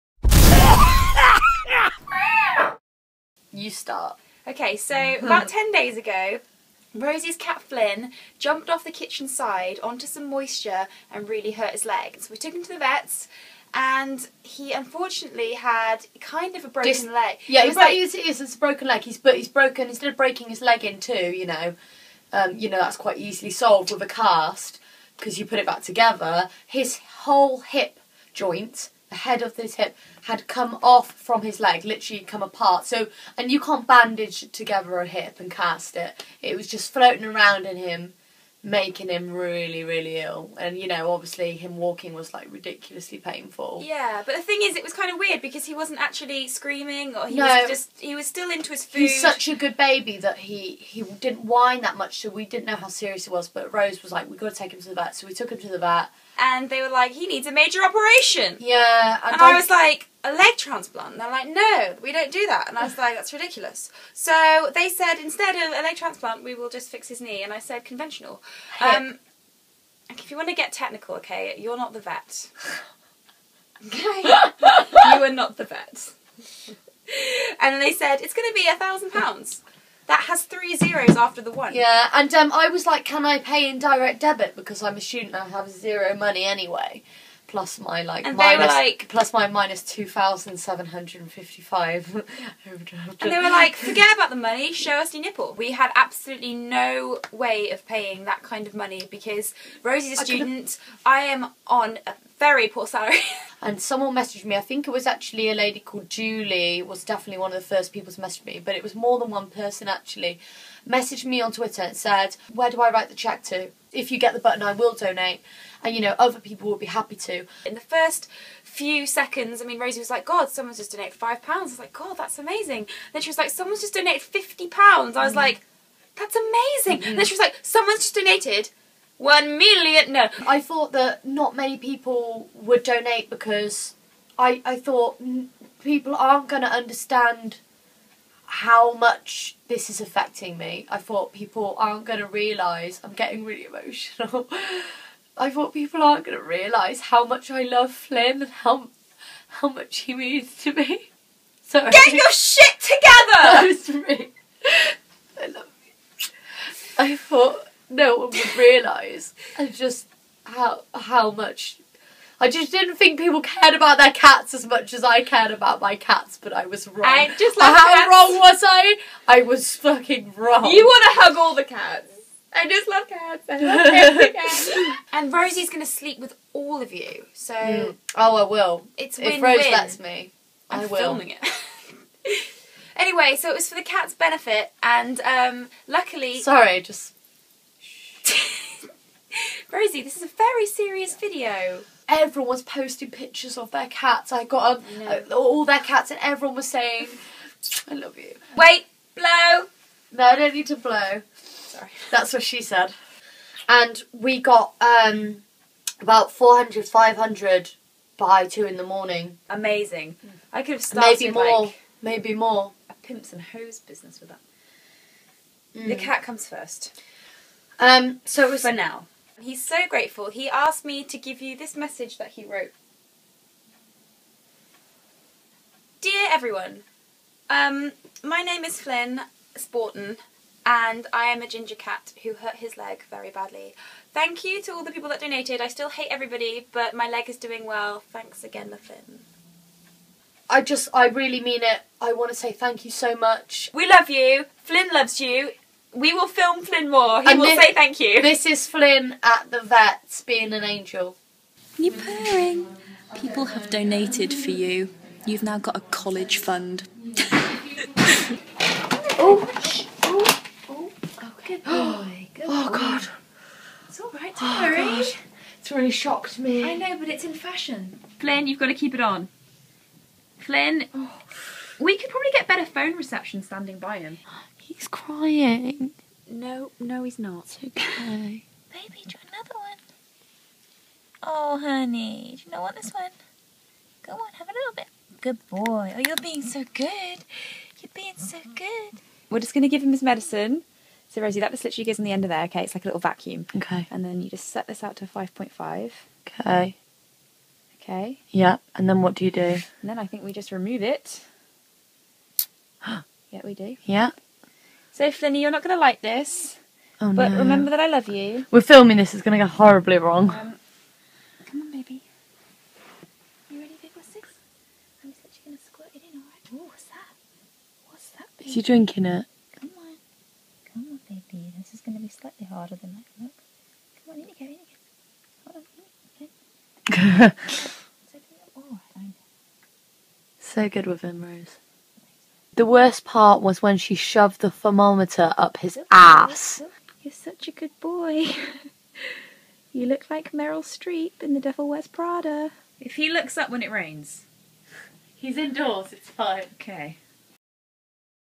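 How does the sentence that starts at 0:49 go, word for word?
He's such a good baby that he he didn't whine that much, so we didn't know how serious it was.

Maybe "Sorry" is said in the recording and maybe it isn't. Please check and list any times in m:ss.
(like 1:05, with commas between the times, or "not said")
3:06, 3:21.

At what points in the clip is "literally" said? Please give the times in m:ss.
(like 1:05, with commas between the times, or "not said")
0:31, 4:51.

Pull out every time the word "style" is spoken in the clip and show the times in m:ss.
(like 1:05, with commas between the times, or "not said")
not said.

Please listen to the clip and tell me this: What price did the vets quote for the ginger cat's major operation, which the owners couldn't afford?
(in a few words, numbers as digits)
£1,000.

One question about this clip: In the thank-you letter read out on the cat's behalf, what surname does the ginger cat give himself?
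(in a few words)
Spaughton.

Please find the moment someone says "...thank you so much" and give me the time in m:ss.
4:02.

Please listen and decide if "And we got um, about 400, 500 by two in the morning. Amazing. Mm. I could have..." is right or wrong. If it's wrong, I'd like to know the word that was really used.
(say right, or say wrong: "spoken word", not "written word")
right.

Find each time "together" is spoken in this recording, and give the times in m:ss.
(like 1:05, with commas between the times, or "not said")
0:25, 0:34, 2:32.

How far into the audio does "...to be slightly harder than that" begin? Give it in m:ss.
5:21.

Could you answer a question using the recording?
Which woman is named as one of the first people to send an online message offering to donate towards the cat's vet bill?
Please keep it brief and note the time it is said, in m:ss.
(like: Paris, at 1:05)
Julie, at 1:46.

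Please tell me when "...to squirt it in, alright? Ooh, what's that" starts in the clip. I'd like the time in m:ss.
5:15.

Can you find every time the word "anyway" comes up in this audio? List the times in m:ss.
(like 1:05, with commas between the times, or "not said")
1:26, 3:02.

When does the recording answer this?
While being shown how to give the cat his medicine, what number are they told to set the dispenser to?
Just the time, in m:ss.
4:55.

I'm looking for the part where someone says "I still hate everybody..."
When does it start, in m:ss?
3:55.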